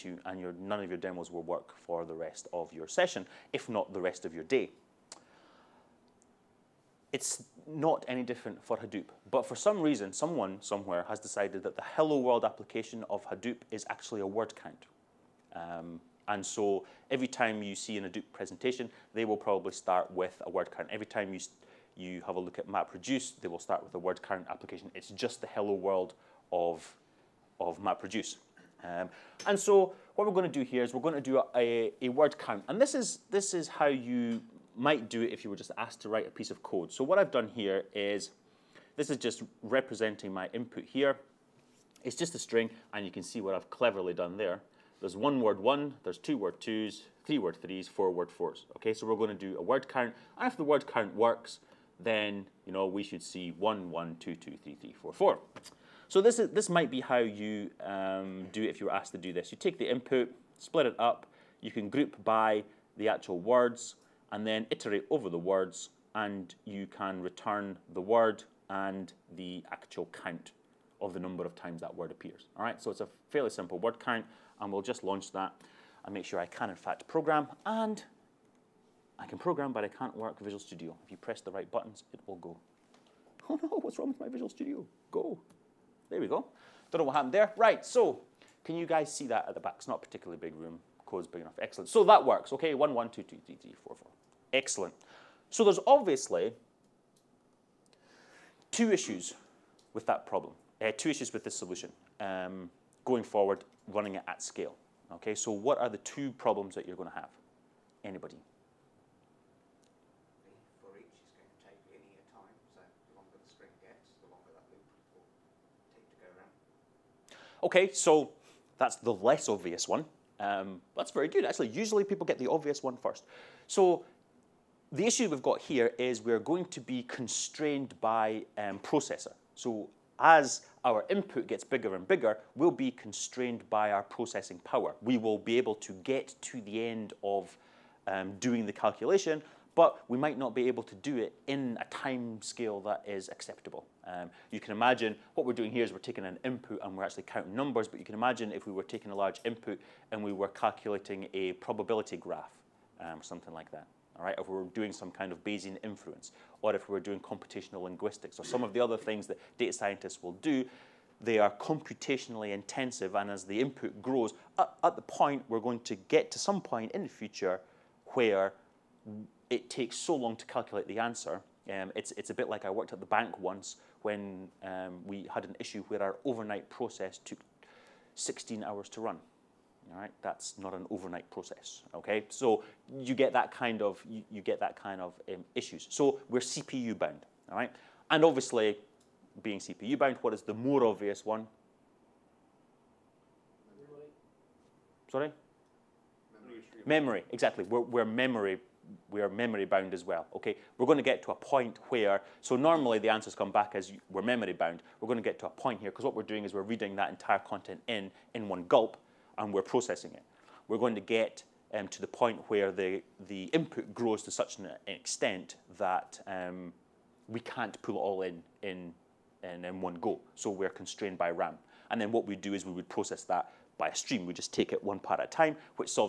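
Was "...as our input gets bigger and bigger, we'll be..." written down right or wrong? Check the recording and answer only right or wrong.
right.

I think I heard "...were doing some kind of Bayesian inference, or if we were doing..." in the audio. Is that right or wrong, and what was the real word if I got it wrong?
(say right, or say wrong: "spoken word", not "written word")
right.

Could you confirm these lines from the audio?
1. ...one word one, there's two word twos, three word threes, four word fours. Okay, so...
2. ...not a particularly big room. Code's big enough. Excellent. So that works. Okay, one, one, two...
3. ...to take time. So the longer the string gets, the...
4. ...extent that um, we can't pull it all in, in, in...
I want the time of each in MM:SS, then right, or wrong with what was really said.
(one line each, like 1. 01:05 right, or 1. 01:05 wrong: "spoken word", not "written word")
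1. 00:45 right
2. 01:29 right
3. 01:51 right
4. 03:34 right.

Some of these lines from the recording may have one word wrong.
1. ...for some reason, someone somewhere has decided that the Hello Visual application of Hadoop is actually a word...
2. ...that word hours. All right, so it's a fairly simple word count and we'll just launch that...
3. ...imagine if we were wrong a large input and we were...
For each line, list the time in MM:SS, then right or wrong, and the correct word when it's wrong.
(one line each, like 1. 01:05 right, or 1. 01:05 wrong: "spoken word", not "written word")
1. 00:09 wrong: "World", not "Visual"
2. 01:11 wrong: "appears", not "hours"
3. 02:28 wrong: "taking", not "wrong".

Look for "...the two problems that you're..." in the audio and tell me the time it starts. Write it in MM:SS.
01:45.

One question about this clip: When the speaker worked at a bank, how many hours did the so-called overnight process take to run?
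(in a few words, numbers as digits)
16.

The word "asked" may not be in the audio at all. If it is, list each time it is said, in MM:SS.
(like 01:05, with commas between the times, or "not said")
00:35, 00:58.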